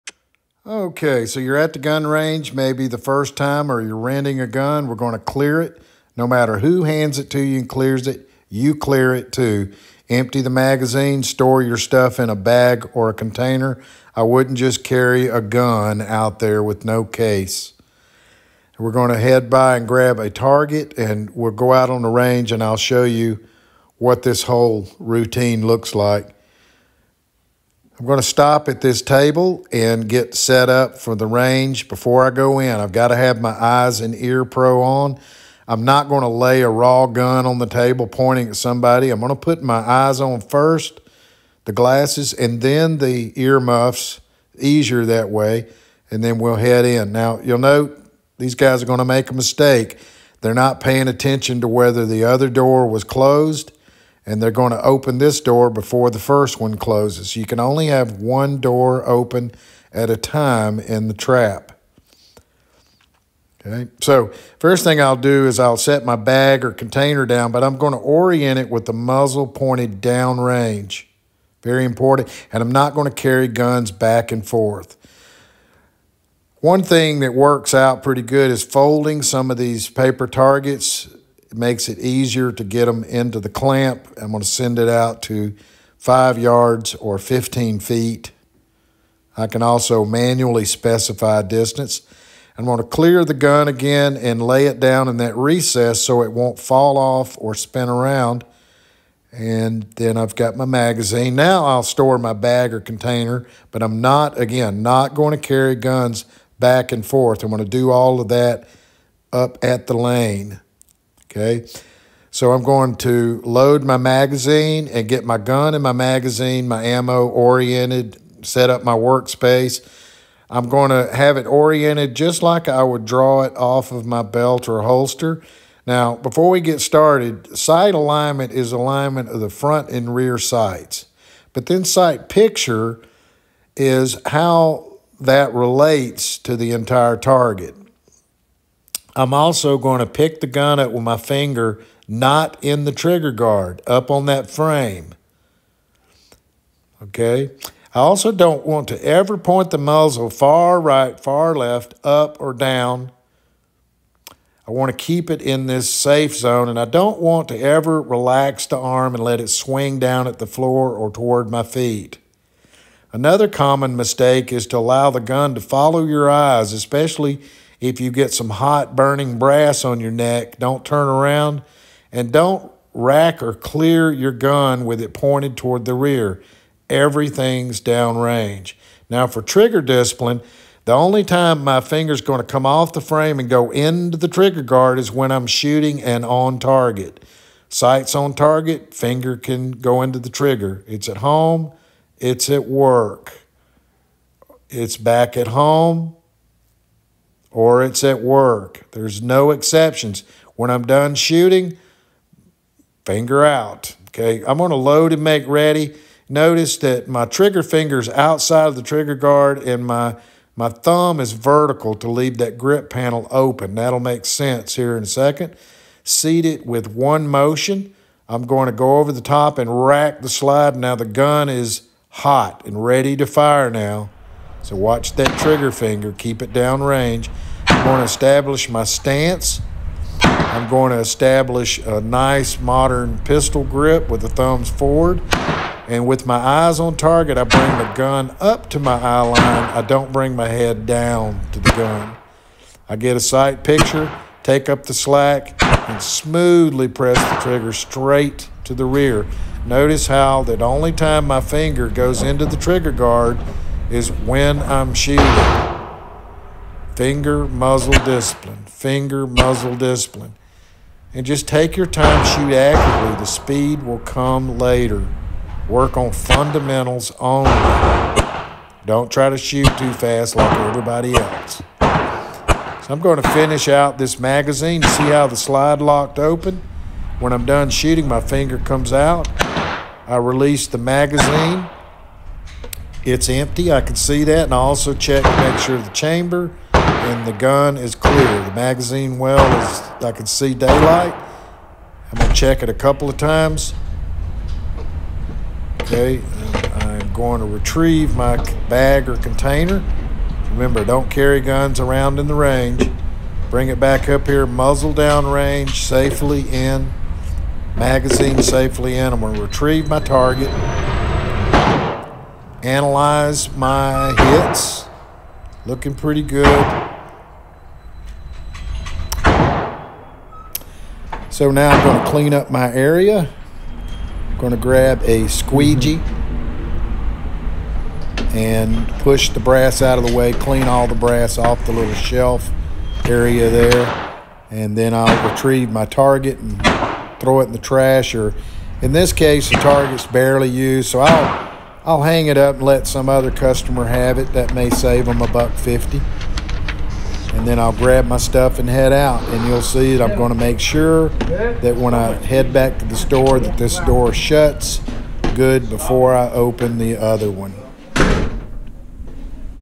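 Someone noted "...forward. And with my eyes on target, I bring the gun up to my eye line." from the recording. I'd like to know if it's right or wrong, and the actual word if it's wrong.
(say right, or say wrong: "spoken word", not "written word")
right.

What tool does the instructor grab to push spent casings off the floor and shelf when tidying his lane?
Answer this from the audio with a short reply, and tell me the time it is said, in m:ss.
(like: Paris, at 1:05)
squeegee, at 5:25.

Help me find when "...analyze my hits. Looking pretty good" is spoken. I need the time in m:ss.
5:12.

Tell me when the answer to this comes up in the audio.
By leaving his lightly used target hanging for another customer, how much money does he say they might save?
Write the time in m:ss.
5:45.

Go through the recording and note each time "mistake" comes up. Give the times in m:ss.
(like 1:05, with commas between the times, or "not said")
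0:49, 2:43.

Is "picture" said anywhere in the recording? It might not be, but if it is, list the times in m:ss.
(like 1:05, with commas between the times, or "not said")
2:12, 4:03.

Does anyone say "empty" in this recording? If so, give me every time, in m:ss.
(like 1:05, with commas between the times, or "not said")
0:10, 4:43.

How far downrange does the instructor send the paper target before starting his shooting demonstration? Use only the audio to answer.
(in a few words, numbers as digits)
5 yards.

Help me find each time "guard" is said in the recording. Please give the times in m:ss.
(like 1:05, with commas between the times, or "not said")
2:23, 3:04, 3:29, 4:12.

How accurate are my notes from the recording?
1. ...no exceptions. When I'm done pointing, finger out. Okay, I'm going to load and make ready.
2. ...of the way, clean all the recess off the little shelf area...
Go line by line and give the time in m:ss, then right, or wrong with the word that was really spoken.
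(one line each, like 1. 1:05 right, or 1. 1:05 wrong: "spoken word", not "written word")
1. 3:19 wrong: "shooting", not "pointing"
2. 5:29 wrong: "brass", not "recess".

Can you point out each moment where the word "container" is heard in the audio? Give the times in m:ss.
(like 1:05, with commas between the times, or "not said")
0:13, 1:06, 1:42, 4:59.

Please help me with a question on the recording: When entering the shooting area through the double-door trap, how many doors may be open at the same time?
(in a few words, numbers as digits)
1.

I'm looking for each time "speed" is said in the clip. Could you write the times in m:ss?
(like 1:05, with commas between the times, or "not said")
4:23.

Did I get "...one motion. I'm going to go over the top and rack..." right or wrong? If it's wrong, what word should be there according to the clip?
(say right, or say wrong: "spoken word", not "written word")
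right.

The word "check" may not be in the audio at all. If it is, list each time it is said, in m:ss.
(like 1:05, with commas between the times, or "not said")
4:44, 4:52.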